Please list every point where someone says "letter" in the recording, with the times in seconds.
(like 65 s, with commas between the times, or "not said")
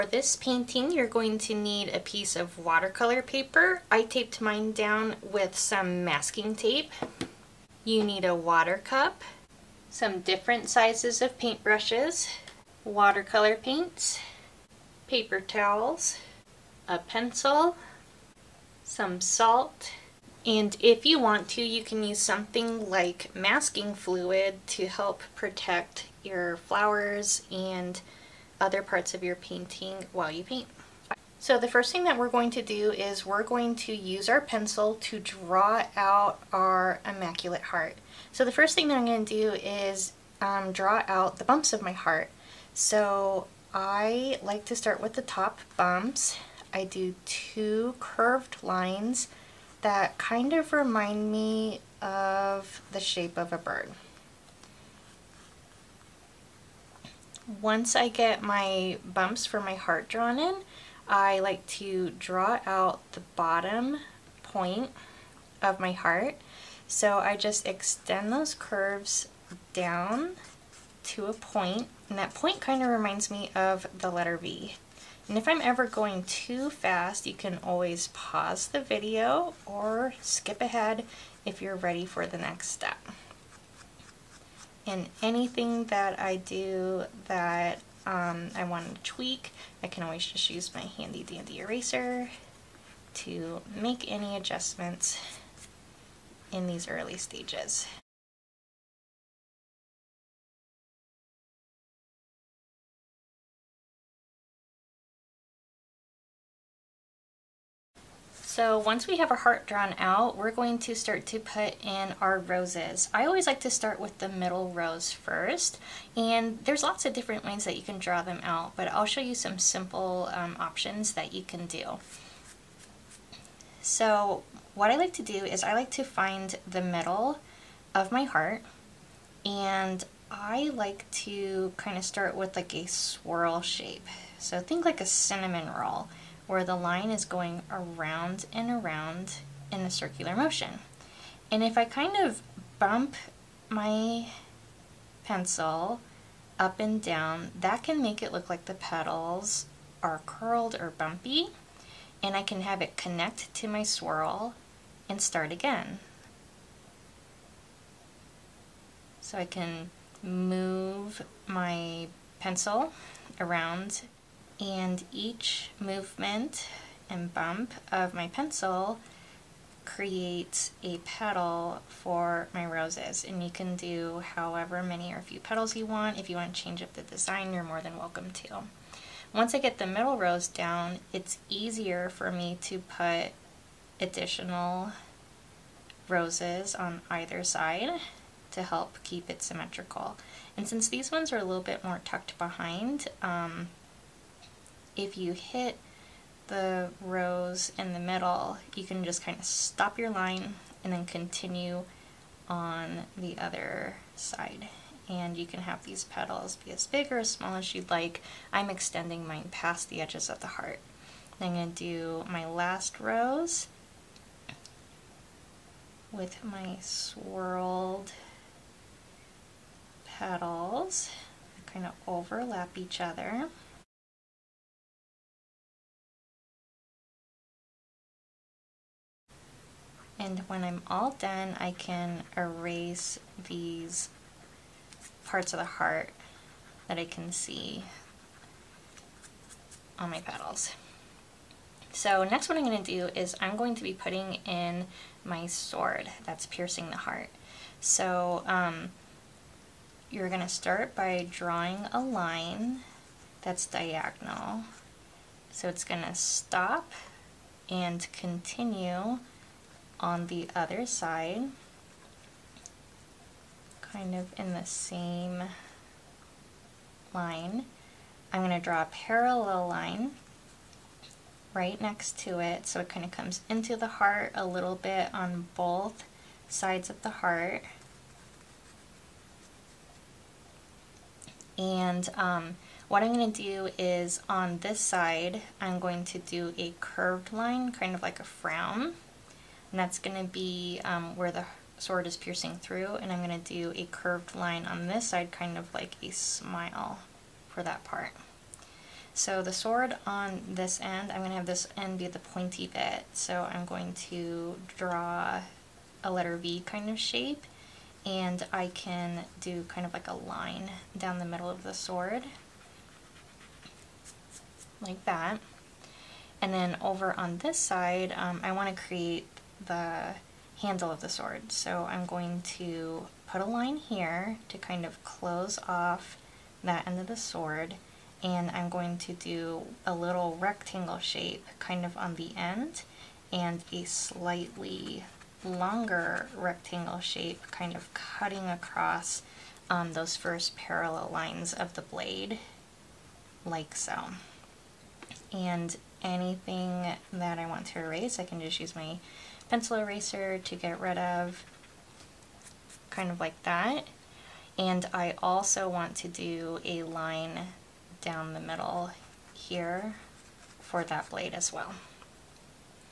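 74 s, 306 s.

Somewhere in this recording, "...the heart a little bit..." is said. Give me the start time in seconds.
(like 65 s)
273 s.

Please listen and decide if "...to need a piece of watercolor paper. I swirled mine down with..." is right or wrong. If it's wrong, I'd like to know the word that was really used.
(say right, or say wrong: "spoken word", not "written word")
wrong: "taped", not "swirled".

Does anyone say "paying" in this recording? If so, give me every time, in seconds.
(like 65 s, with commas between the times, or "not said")
not said.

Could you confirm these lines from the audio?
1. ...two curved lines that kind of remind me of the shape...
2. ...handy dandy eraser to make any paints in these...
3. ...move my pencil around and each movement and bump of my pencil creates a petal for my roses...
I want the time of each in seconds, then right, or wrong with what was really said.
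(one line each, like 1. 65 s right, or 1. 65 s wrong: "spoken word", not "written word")
1. 47 s right
2. 90 s wrong: "adjustments", not "paints"
3. 160 s right.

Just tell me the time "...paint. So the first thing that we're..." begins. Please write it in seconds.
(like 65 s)
30 s.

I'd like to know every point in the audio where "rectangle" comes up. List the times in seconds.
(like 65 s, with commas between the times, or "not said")
330 s, 336 s.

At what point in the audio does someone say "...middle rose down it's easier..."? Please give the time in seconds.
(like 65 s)
179 s.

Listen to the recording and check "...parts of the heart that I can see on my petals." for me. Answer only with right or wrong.
right.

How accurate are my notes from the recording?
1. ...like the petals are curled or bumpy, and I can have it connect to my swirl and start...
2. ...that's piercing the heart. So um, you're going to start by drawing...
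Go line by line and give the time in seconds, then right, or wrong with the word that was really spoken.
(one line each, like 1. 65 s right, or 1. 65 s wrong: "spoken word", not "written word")
1. 148 s right
2. 246 s right.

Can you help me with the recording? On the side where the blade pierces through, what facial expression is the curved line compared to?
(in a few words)
a frown.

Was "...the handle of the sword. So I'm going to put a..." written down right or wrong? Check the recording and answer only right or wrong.
right.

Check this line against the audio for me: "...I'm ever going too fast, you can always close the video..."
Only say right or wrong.
wrong.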